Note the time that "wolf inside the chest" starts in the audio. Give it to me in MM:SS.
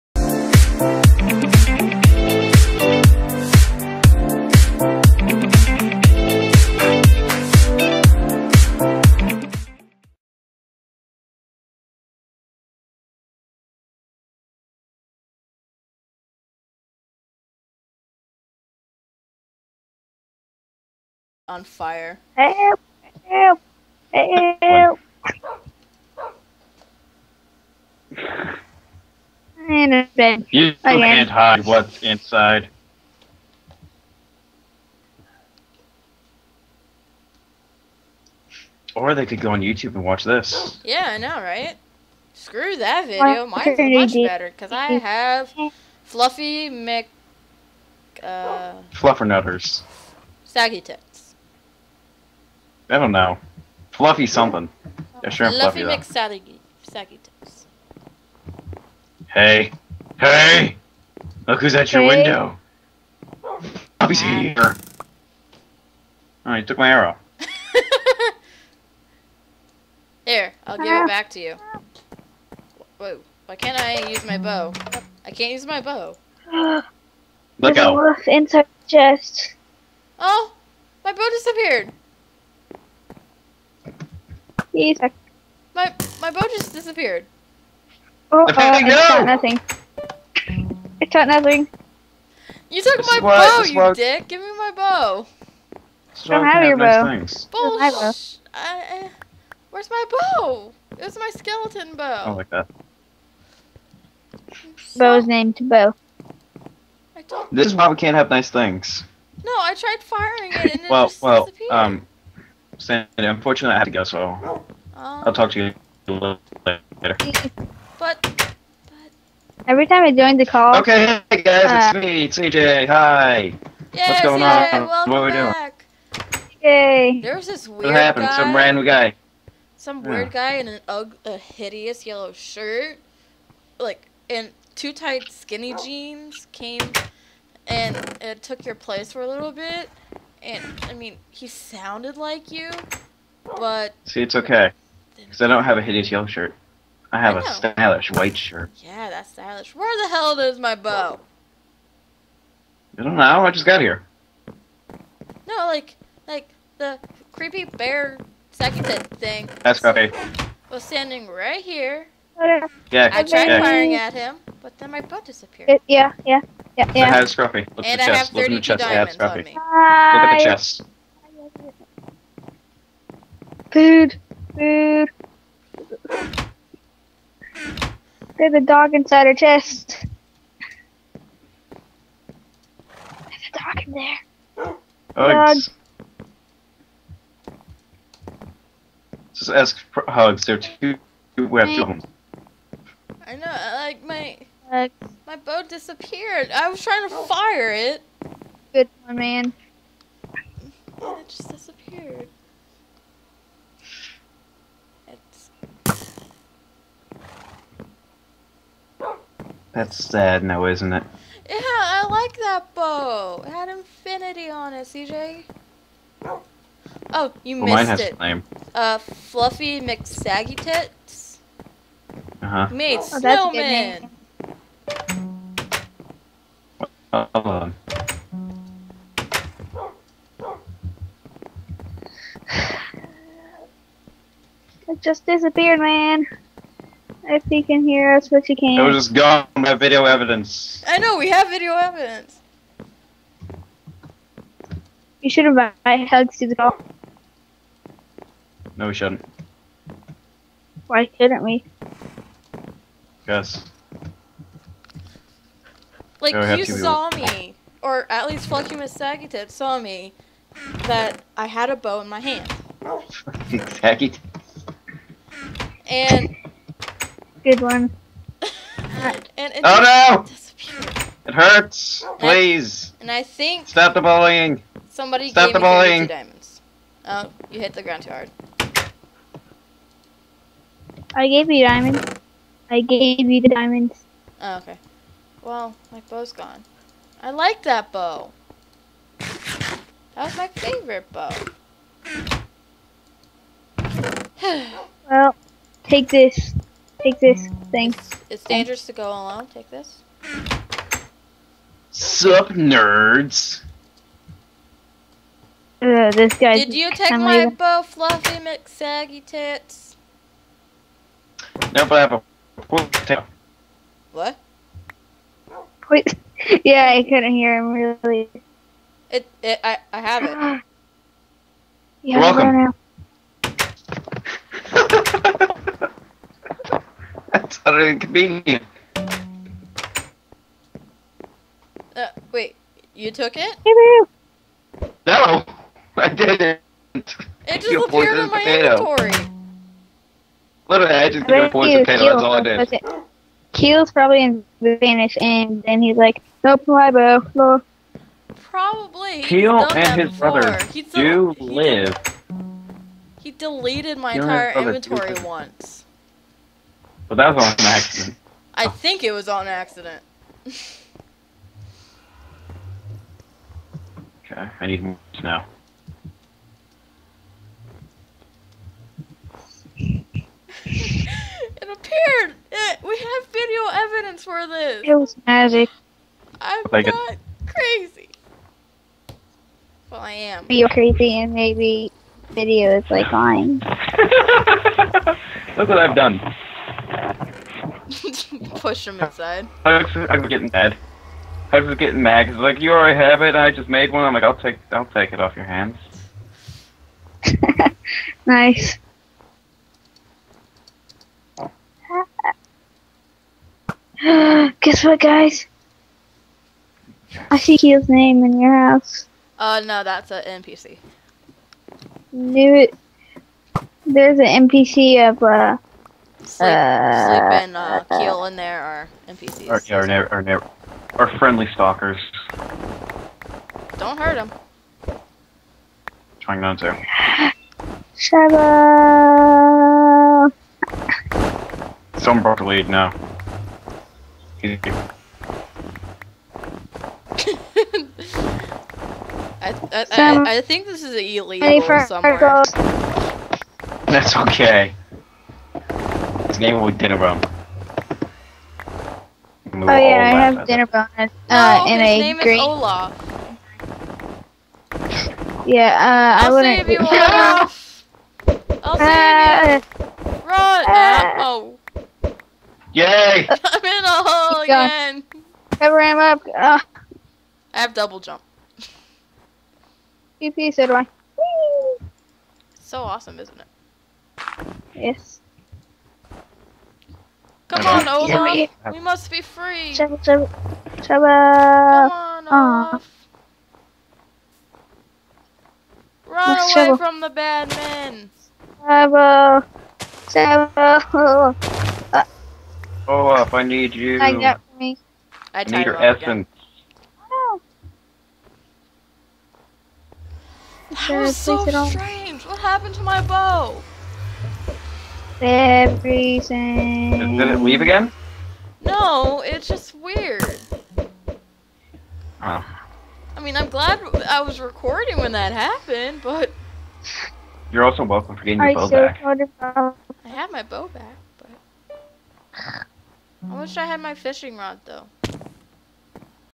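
01:17.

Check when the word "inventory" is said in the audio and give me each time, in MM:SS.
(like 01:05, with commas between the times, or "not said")
05:38, 05:54.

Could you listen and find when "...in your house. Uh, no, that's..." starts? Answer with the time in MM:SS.
06:48.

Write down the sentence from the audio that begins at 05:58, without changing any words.
I think it was on accident.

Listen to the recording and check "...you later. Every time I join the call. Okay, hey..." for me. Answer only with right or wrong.
right.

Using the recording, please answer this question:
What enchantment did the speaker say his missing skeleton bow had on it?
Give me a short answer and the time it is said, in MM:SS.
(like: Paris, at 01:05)
Infinity, at 03:33.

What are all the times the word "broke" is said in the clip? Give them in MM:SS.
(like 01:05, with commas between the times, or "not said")
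07:12.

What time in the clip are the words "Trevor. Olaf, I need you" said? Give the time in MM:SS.
08:10.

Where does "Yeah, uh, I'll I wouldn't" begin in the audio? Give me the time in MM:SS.
07:35.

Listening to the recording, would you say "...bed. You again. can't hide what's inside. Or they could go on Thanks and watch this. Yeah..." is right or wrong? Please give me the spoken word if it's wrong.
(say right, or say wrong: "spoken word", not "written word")
wrong: "YouTube", not "Thanks".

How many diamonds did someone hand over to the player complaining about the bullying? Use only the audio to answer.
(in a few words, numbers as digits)
2.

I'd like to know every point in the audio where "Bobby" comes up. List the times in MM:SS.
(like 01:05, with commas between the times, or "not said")
01:03.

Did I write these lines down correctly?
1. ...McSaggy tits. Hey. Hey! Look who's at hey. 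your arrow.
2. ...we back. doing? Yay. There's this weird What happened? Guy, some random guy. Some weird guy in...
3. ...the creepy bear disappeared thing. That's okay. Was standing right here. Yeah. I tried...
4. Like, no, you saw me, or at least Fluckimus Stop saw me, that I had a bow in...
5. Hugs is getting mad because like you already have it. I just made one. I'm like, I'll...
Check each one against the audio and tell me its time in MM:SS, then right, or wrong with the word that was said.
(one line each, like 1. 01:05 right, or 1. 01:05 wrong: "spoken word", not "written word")
1. 00:56 wrong: "window", not "arrow"
2. 02:05 right
3. 02:36 wrong: "seconded", not "disappeared"
4. 04:16 wrong: "Sagittip", not "Stop"
5. 06:31 right.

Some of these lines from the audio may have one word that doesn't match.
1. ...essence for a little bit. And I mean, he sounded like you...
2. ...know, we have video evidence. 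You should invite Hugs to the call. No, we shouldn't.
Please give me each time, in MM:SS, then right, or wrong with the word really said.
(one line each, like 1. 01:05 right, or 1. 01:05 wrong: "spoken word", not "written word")
1. 02:18 wrong: "place", not "essence"
2. 04:00 right.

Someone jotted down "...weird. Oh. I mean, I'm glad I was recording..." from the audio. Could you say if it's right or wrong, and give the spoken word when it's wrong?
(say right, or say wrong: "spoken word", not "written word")
right.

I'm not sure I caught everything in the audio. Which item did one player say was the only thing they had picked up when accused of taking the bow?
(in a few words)
poison potato.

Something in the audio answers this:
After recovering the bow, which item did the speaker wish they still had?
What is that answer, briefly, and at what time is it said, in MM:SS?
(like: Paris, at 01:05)
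fishing rod, at 08:43.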